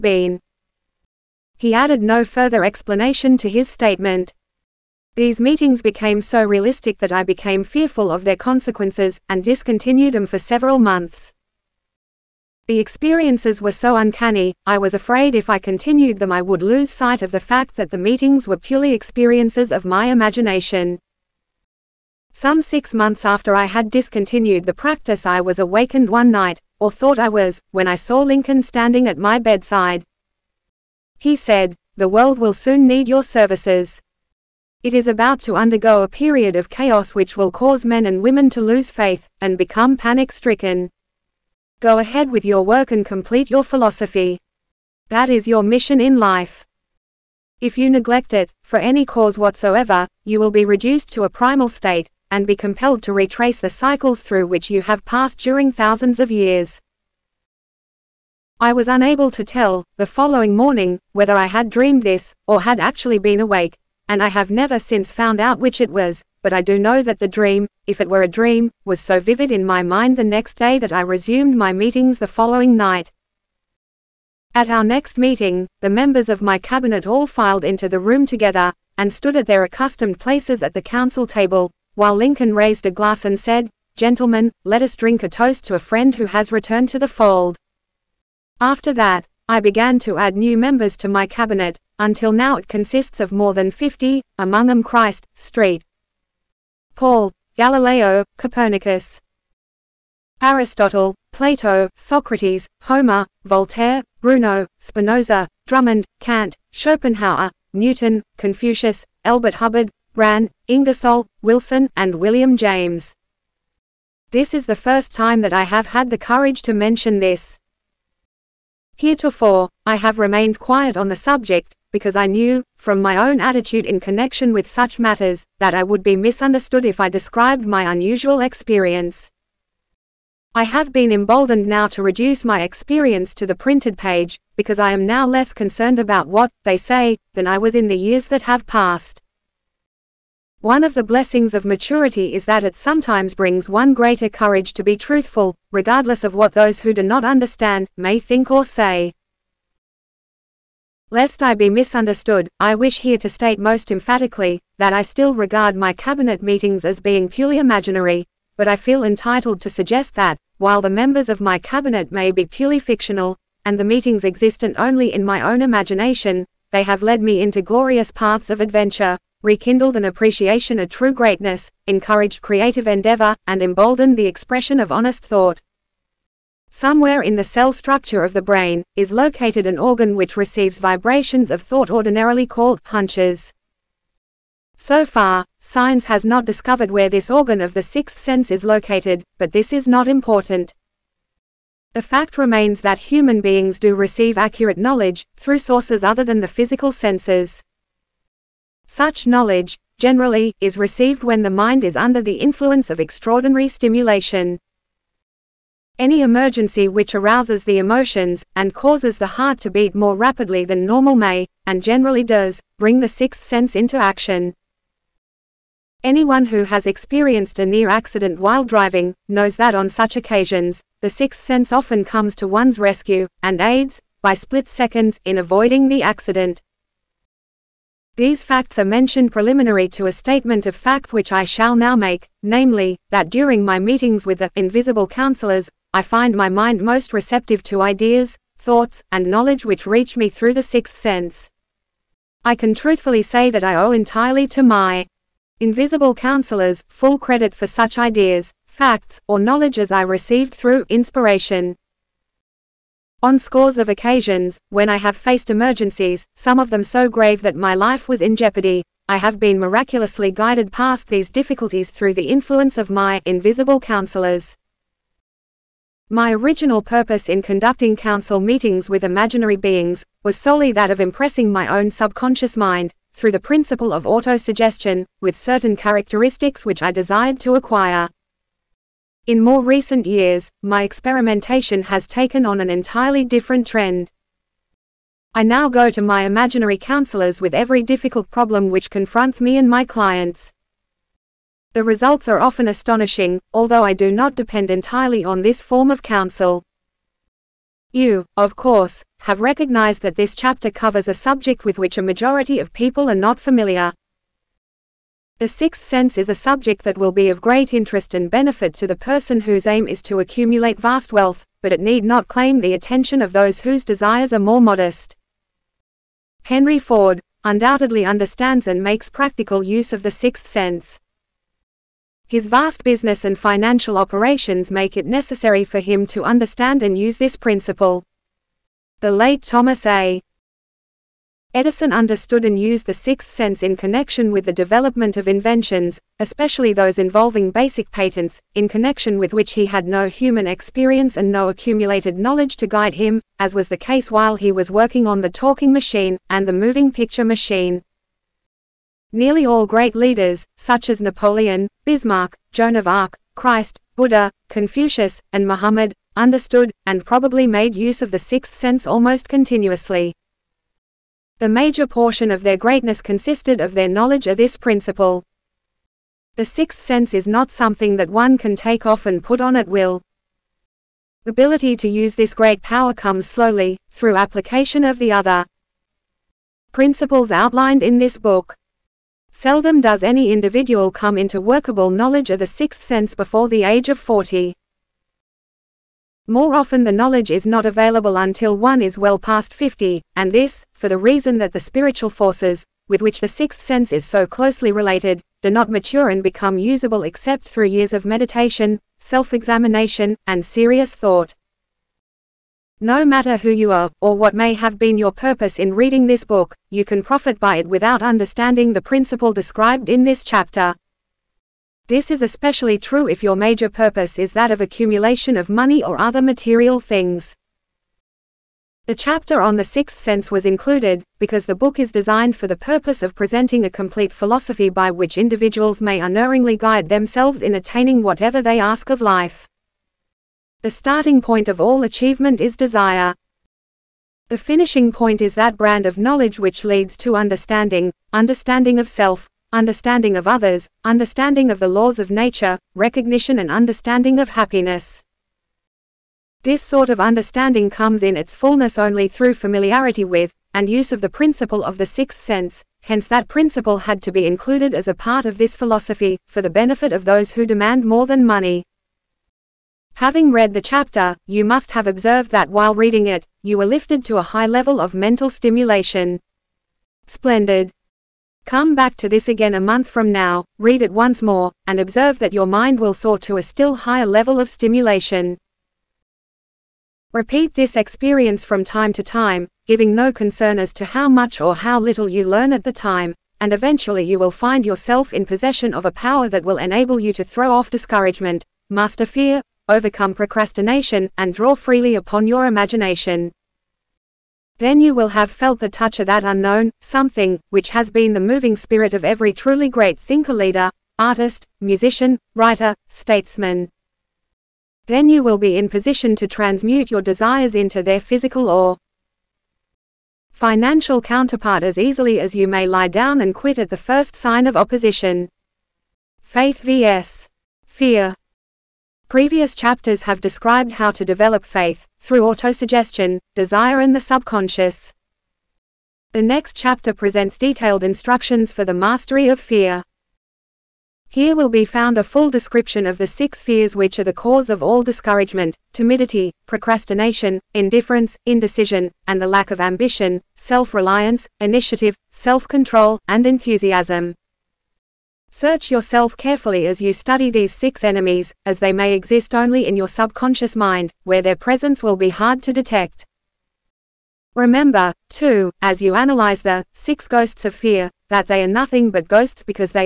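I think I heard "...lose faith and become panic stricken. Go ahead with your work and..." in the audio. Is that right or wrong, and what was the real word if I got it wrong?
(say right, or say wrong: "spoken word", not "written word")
right.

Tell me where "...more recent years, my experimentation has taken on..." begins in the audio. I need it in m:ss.
4:39.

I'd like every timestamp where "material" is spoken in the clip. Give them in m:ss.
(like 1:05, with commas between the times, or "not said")
6:56.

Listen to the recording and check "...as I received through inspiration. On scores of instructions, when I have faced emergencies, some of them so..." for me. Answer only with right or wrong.
wrong.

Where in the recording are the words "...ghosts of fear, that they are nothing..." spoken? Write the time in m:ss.
9:17.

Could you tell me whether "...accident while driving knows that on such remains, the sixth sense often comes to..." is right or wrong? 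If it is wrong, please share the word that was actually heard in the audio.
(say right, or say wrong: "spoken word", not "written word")
wrong: "occasions", not "remains".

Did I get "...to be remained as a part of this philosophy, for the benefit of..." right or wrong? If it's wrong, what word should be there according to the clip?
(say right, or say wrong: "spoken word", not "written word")
wrong: "included", not "remained".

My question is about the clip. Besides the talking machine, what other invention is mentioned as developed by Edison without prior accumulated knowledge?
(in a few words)
moving picture machine.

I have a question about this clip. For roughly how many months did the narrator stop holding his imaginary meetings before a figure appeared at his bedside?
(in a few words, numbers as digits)
6.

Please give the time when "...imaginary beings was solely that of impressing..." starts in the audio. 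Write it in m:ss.
4:29.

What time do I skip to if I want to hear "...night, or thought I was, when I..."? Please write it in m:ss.
0:26.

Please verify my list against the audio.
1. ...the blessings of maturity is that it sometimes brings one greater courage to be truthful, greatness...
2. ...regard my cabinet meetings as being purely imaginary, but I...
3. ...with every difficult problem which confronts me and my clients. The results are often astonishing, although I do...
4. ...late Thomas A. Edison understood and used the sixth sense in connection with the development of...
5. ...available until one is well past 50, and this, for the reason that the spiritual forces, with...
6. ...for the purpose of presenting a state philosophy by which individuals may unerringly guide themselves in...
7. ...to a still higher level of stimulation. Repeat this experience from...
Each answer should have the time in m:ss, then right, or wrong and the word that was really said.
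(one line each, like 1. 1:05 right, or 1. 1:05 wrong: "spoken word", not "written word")
1. 2:20 wrong: "regardless", not "greatness"
2. 2:35 right
3. 4:47 right
4. 5:29 right
5. 6:27 right
6. 7:02 wrong: "complete", not "state"
7. 7:53 right.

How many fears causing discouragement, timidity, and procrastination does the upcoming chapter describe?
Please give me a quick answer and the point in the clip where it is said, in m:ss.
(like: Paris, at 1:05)
6, at 8:53.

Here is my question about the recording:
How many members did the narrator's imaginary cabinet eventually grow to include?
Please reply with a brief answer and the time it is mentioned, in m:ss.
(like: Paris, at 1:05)
more than 50, at 1:33.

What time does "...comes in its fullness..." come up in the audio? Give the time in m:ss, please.
7:27.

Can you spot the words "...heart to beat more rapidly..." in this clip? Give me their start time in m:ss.
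3:29.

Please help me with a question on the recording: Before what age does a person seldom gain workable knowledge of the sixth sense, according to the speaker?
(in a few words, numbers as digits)
40.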